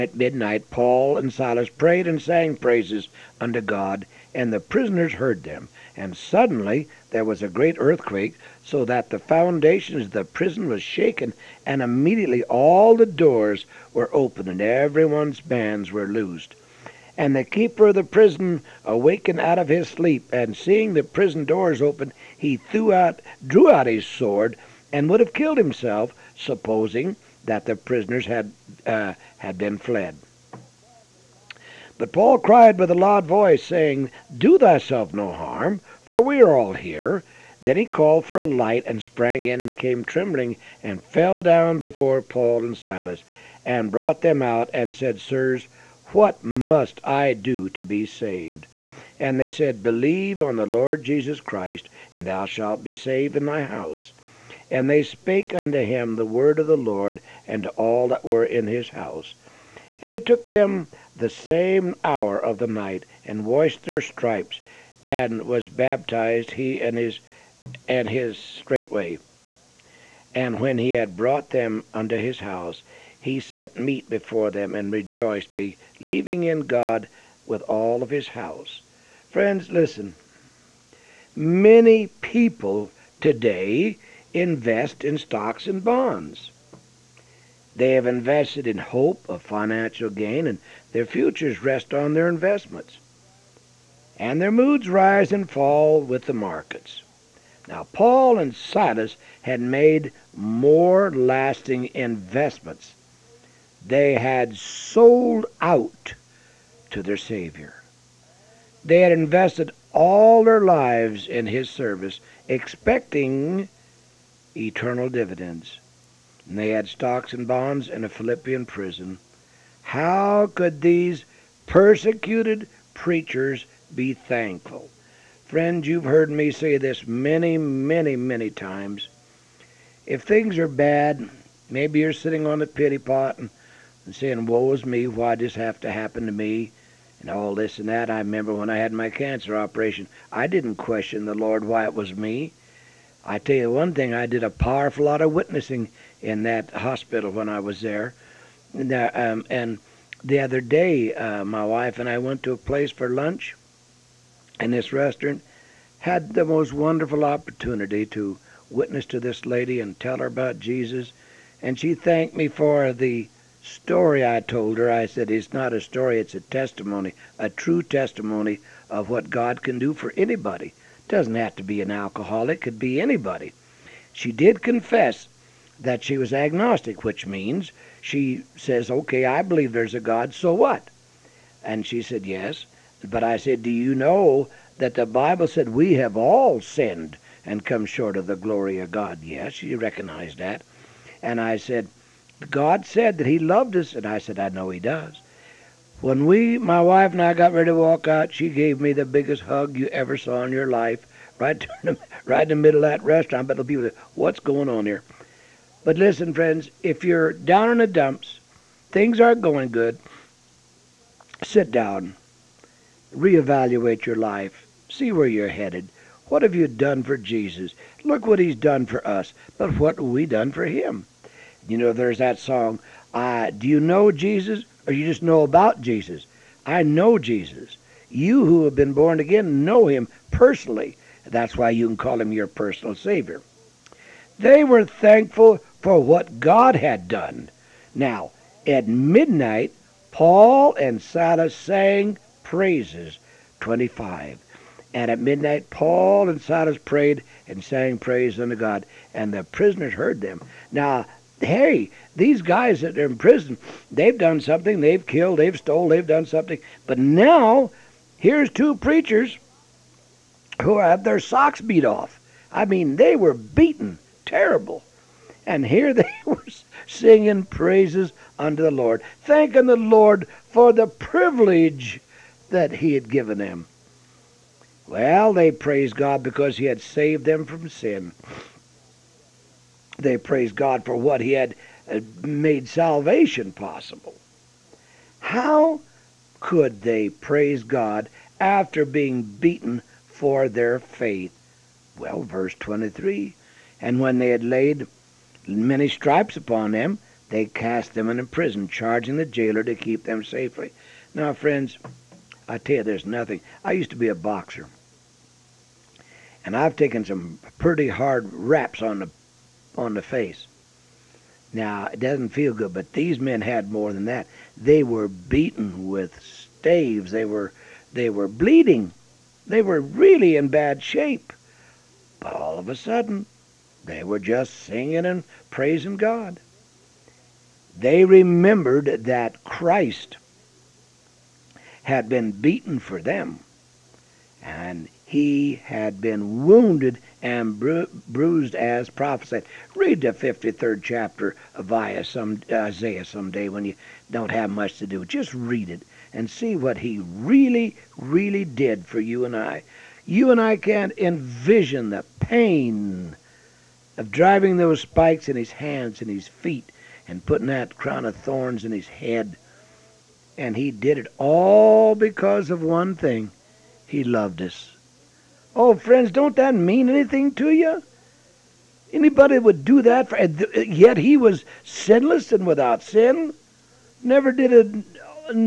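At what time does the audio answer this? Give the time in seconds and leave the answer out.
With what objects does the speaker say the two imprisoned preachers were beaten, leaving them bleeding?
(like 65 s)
316 s.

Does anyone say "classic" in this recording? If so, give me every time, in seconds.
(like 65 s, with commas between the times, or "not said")
not said.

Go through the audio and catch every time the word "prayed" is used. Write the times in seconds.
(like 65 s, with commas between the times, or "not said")
1 s, 246 s.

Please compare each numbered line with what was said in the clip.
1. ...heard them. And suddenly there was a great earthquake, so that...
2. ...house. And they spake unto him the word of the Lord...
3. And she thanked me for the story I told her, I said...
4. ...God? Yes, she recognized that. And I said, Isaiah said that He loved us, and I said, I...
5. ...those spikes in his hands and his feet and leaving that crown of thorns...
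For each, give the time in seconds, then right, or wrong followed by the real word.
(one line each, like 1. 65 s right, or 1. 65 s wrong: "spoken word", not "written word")
1. 5 s right
2. 53 s right
3. 161 s right
4. 188 s wrong: "God", not "Isaiah"
5. 354 s wrong: "putting", not "leaving".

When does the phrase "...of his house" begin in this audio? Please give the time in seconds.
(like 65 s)
78 s.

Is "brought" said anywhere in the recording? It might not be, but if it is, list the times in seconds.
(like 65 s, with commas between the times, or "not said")
43 s, 71 s.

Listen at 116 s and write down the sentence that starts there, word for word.
And they had stocks and bonds in a Philippian prison.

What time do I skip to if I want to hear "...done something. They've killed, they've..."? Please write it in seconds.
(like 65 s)
254 s.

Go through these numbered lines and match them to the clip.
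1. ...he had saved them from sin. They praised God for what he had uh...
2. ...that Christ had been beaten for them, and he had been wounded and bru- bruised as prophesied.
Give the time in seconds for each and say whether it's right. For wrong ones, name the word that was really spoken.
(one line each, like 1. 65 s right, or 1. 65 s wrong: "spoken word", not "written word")
1. 276 s right
2. 329 s right.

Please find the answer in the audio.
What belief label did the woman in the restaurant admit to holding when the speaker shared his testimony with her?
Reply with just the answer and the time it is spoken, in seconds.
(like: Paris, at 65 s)
agnostic, at 176 s.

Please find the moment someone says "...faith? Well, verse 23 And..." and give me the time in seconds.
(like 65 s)
290 s.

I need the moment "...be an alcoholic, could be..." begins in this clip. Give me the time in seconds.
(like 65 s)
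171 s.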